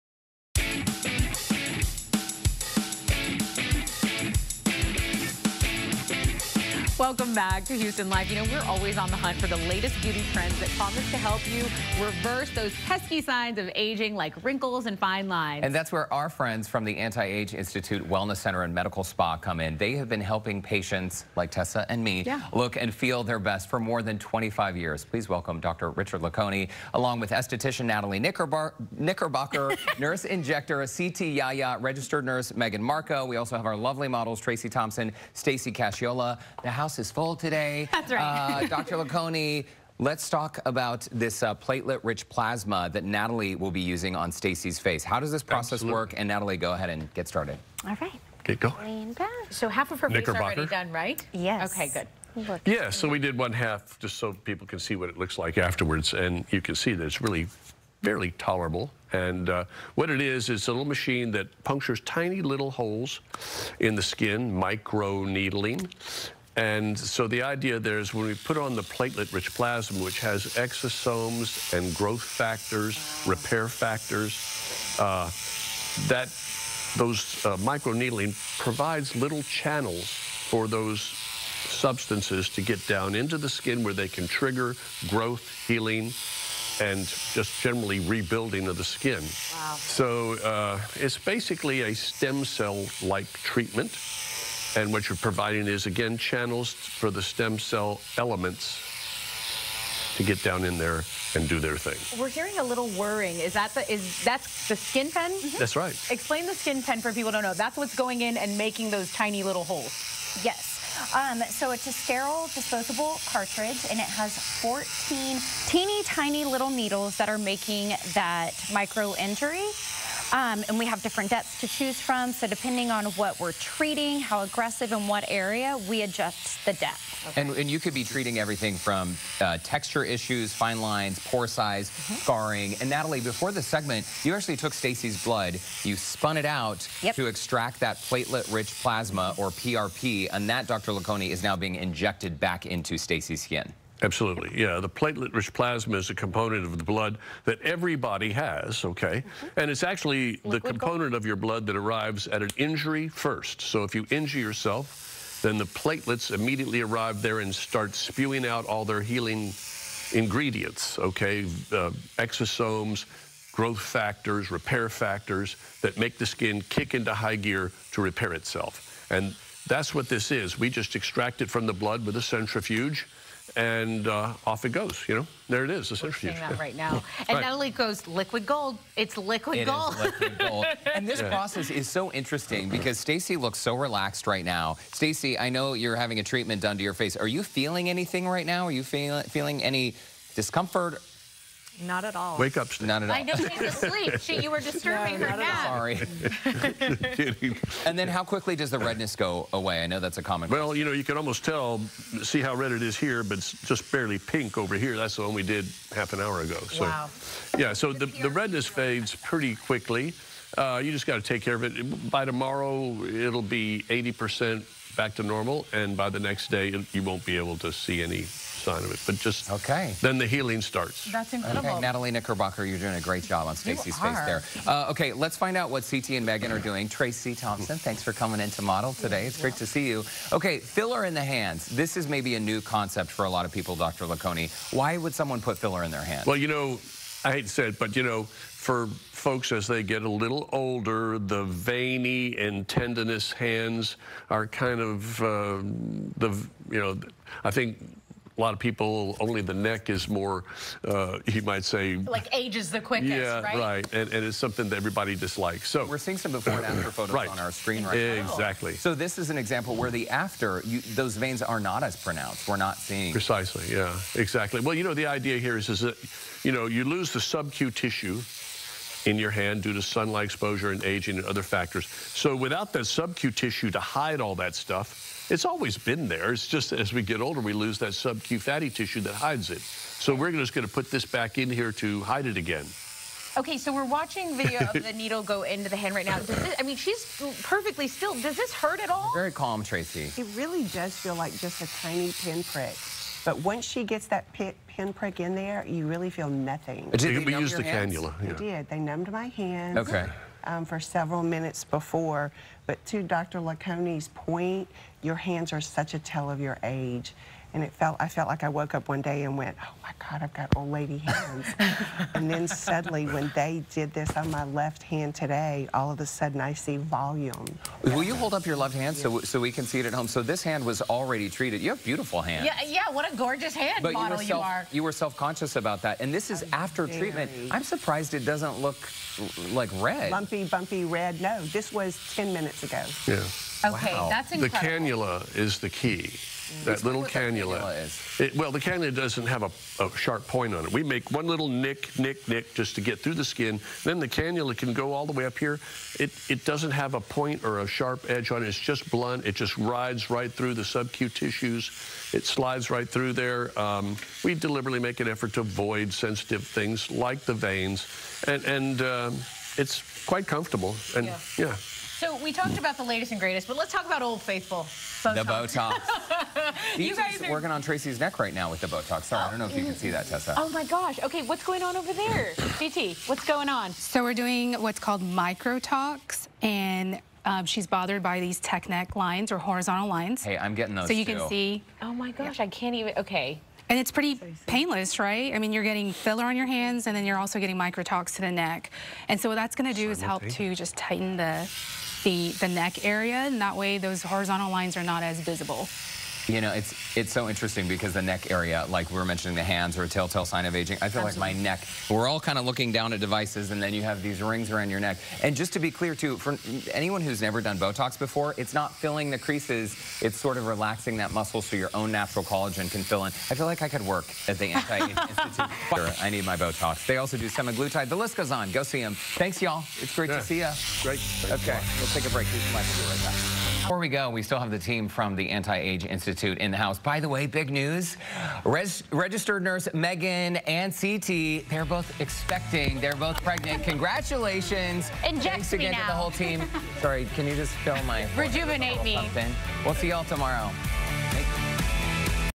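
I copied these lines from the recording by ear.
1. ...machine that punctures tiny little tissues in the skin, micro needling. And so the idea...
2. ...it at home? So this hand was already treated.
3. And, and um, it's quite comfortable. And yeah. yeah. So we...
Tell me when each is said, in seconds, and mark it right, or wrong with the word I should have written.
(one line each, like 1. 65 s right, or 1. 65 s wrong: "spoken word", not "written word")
1. 60 s wrong: "holes", not "tissues"
2. 319 s right
3. 358 s right.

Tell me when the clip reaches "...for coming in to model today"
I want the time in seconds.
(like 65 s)
228 s.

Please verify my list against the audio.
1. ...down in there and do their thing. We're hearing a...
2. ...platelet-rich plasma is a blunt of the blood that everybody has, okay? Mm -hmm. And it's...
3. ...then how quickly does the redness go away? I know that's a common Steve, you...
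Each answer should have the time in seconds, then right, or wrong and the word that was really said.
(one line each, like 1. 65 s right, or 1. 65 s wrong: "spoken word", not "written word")
1. 100 s right
2. 144 s wrong: "component", not "blunt"
3. 197 s wrong: "Well", not "Steve".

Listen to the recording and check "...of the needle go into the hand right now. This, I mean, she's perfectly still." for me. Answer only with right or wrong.
right.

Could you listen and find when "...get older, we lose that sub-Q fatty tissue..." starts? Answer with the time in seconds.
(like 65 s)
277 s.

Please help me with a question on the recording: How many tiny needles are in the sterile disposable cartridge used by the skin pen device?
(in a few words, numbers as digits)
14.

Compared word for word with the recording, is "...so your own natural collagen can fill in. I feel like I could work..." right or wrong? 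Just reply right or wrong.
right.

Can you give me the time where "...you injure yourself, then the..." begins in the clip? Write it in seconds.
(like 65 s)
153 s.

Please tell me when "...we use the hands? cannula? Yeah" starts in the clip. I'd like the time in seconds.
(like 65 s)
297 s.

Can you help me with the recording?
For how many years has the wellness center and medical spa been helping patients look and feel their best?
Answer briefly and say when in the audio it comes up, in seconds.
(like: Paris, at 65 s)
25 years, at 23 s.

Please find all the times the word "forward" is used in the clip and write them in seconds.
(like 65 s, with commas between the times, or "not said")
not said.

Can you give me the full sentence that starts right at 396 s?
You know, it's it's so interesting because the neck area, like we were mentioning the hands are a telltale sign of aging.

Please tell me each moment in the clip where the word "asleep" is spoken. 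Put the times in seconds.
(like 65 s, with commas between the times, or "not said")
193 s.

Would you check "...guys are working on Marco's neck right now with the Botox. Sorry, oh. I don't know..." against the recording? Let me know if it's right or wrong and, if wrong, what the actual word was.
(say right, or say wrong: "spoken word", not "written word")
wrong: "Tracy", not "Marco".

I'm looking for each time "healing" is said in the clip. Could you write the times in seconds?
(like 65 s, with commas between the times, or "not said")
85 s, 159 s, 220 s.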